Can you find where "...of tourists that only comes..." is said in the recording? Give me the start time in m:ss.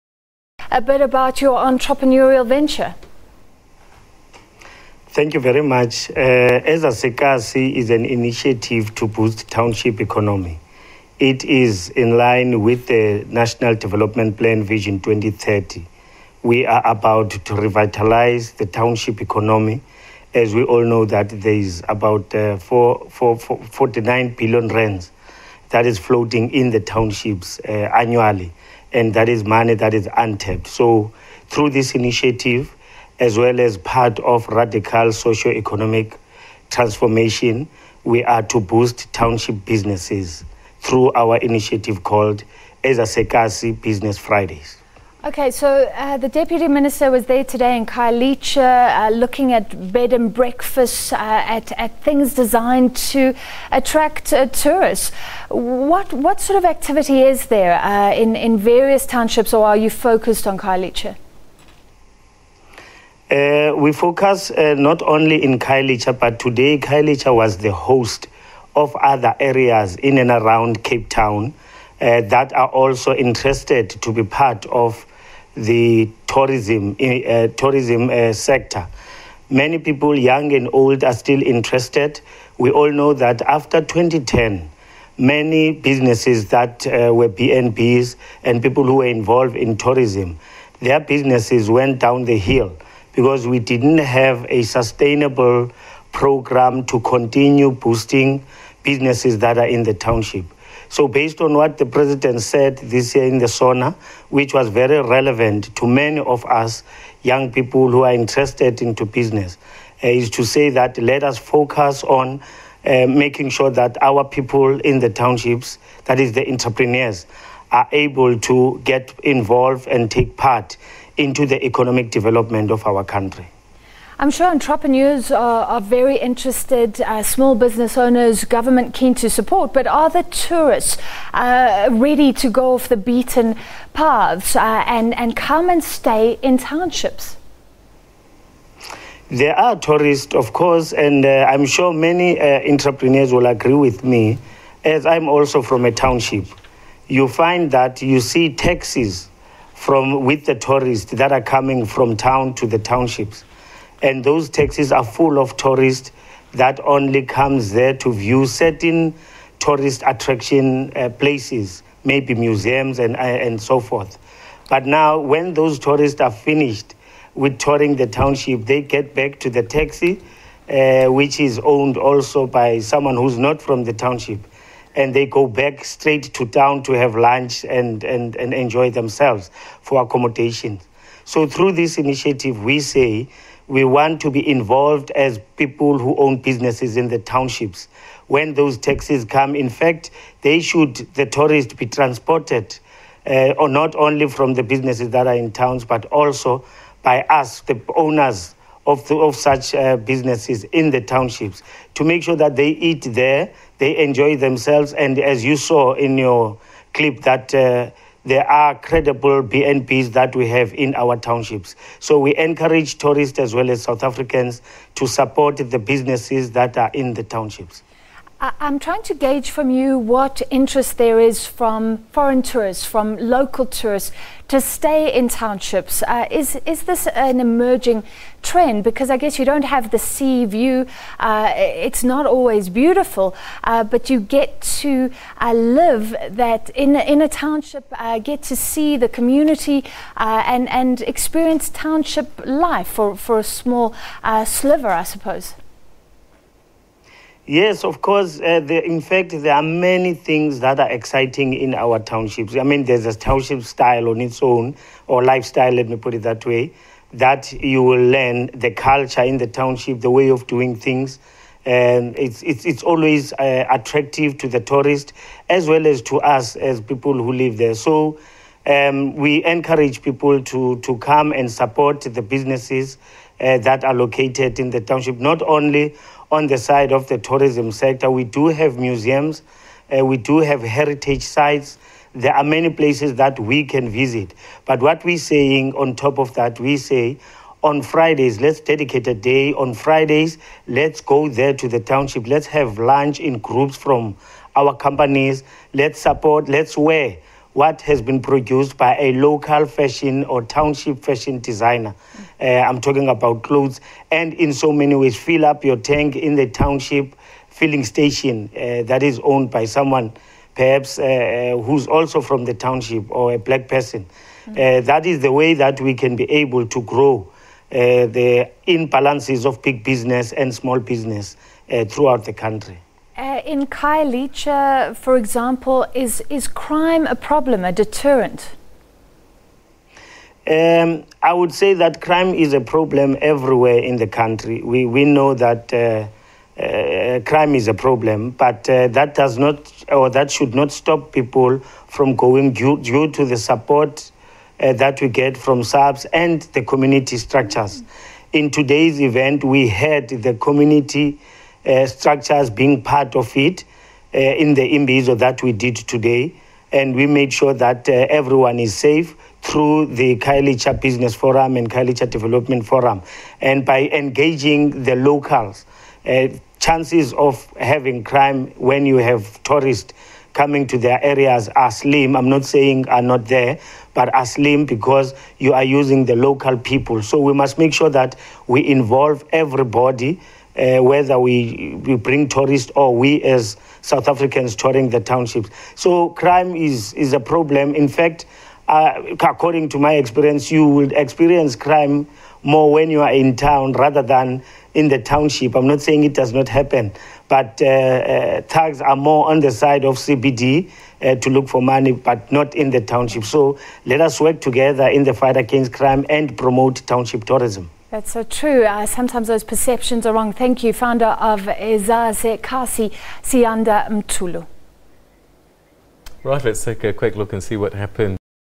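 2:35.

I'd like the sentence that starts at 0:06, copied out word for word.
Uh, As is an initiative to boost township economy.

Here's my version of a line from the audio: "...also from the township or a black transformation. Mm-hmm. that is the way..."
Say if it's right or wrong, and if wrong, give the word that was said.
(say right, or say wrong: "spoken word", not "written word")
wrong: "person", not "transformation".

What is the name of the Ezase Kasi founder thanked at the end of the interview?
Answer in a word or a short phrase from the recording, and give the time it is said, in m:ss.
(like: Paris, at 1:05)
Siyanda Mtulu, at 6:53.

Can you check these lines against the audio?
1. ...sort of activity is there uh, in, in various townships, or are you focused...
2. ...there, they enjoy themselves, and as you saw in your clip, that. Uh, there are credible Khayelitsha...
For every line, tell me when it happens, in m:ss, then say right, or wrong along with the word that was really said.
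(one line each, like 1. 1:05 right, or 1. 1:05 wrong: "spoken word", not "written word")
1. 0:56 right
2. 3:23 wrong: "BNBs", not "Khayelitsha".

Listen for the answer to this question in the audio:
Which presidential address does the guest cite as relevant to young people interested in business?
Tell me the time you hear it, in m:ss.
1:43.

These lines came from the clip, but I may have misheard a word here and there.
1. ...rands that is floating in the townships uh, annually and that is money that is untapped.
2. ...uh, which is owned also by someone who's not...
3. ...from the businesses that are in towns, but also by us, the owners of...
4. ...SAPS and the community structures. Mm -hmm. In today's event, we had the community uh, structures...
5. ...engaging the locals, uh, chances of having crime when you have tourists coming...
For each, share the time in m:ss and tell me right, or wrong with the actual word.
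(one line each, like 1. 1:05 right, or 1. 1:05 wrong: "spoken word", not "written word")
1. 0:24 right
2. 2:50 right
3. 3:14 right
4. 5:45 right
5. 6:03 right.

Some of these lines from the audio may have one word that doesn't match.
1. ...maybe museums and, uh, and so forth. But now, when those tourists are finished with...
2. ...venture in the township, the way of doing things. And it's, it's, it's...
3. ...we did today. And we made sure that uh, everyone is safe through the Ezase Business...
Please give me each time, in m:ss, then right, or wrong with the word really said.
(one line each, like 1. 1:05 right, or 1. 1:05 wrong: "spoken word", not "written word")
1. 2:42 right
2. 4:18 wrong: "culture", not "venture"
3. 5:55 wrong: "Khayelitsha", not "Ezase".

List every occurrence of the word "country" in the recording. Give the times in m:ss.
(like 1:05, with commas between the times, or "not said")
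2:03, 5:22, 5:34.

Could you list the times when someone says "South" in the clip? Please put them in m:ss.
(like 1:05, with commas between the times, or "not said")
3:33, 6:23.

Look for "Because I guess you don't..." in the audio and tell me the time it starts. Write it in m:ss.
3:48.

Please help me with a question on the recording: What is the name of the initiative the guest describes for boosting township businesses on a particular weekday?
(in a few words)
Ezase Kasi Business Fridays.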